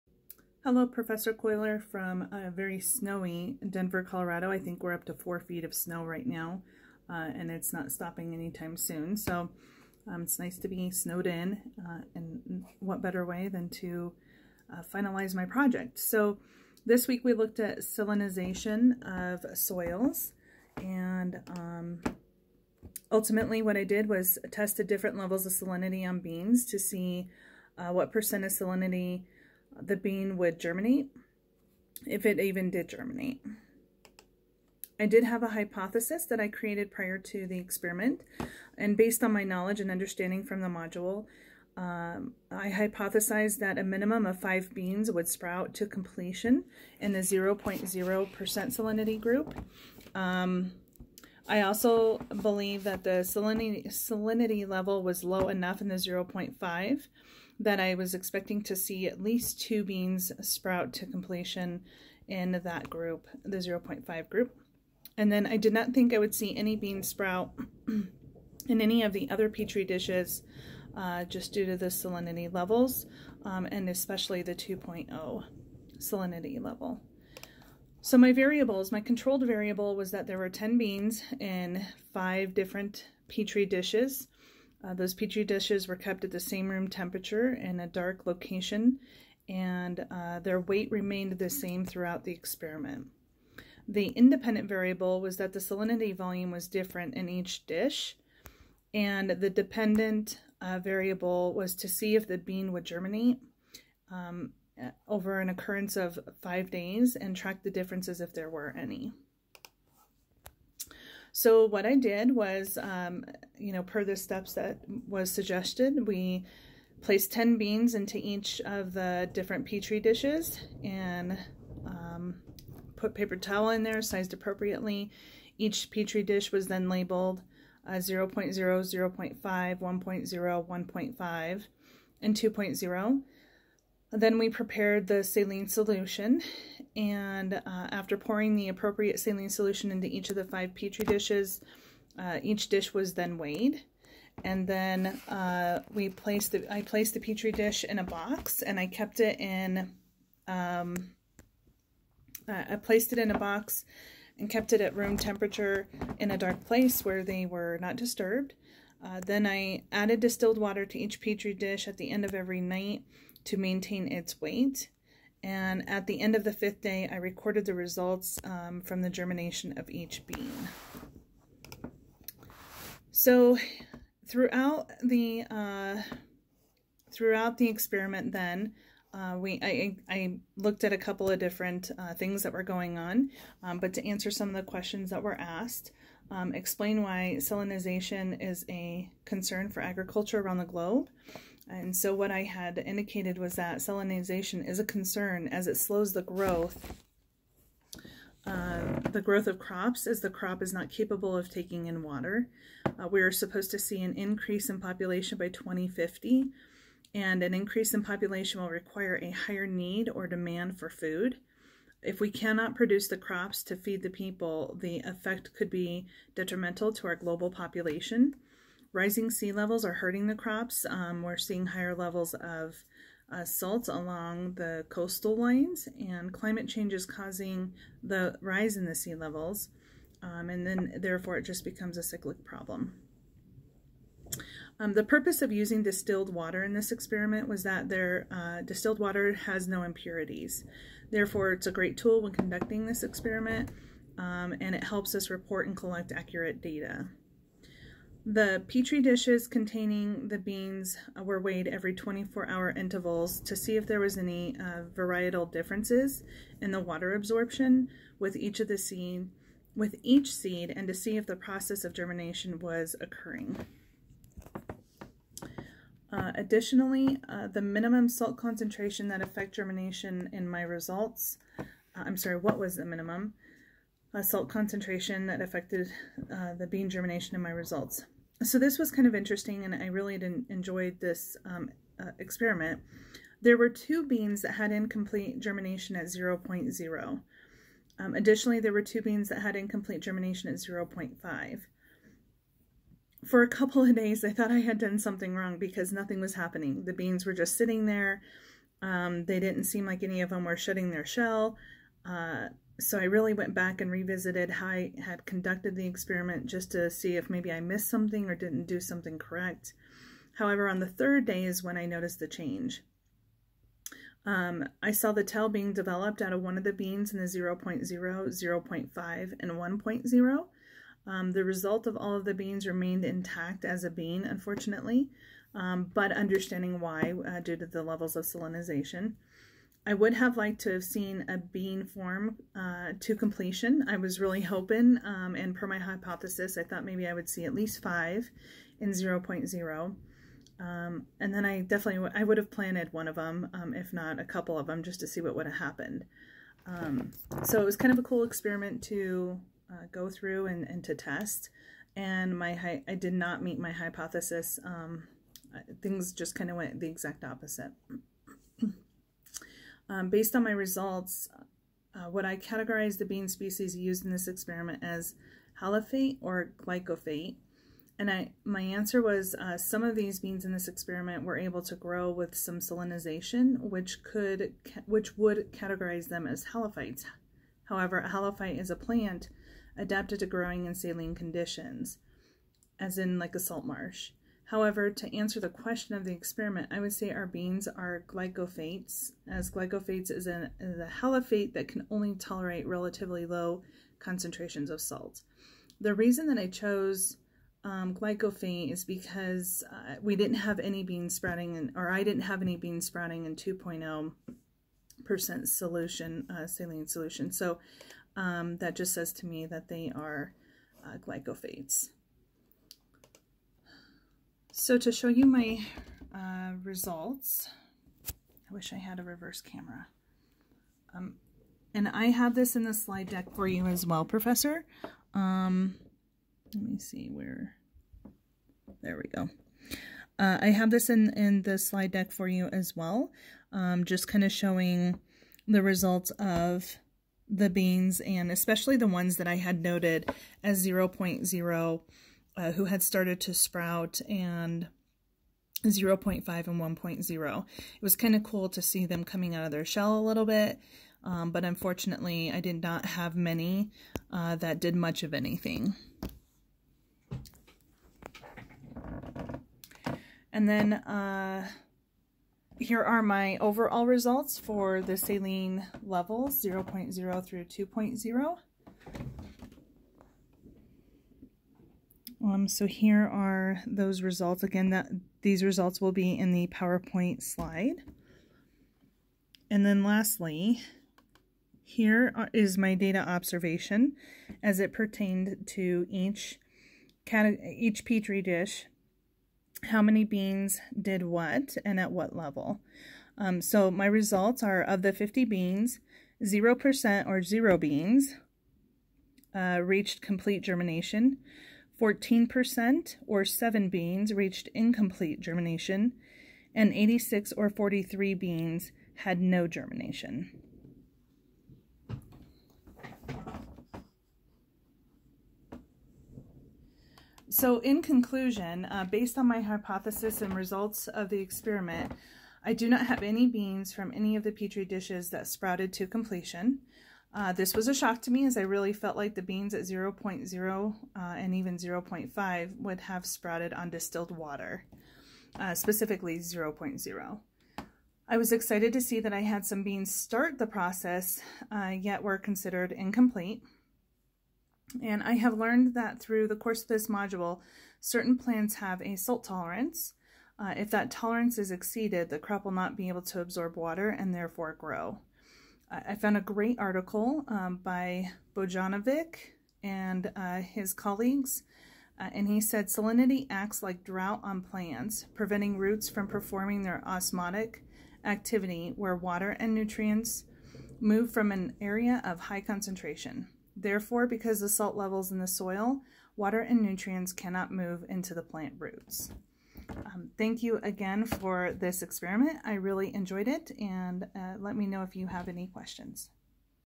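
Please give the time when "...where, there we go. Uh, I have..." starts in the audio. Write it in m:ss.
7:07.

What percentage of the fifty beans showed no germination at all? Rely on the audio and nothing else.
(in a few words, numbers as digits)
86%.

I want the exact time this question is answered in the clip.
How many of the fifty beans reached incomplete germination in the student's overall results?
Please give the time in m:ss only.
8:23.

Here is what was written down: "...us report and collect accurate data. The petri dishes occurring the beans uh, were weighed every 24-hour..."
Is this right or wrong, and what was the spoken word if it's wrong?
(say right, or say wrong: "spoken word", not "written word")
wrong: "containing", not "occurring".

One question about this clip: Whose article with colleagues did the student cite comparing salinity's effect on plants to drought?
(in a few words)
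Bojanovic.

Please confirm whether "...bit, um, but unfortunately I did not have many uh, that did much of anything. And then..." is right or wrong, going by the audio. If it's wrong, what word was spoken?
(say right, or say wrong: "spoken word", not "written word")
right.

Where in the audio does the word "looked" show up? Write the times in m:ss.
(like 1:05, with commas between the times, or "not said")
0:17, 3:00.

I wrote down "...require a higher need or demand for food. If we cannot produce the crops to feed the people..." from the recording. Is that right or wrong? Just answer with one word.
right.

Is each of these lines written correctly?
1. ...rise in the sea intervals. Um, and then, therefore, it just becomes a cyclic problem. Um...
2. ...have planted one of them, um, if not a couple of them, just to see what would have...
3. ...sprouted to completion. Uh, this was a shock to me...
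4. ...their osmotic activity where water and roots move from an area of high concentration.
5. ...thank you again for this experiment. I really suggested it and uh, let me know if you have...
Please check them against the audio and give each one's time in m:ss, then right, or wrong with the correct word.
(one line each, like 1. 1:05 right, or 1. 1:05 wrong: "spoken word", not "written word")
1. 3:48 wrong: "levels", not "intervals"
2. 5:42 right
3. 8:45 right
4. 9:26 wrong: "nutrients", not "roots"
5. 9:40 wrong: "enjoyed", not "suggested".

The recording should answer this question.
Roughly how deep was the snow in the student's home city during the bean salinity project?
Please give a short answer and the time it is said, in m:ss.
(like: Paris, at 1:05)
4 feet, at 0:05.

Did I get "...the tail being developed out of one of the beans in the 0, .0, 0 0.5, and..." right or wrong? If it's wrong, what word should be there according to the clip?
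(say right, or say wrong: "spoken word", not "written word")
right.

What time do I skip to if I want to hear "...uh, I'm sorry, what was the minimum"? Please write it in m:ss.
4:31.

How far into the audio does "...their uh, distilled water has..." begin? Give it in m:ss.
3:57.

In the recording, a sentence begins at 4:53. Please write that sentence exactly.
For a couple of days, I thought I had done something wrong because nothing was happening.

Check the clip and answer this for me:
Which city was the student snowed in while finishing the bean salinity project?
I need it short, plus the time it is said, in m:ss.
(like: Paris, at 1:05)
Denver, at 0:03.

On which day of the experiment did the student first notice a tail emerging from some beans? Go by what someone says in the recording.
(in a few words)
third day.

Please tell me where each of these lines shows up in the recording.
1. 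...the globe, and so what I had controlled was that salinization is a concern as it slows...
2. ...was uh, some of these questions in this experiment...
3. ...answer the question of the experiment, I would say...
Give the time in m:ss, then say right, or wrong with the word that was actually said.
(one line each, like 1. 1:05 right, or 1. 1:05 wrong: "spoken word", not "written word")
1. 3:10 wrong: "indicated", not "controlled"
2. 6:09 wrong: "beans", not "questions"
3. 6:25 right.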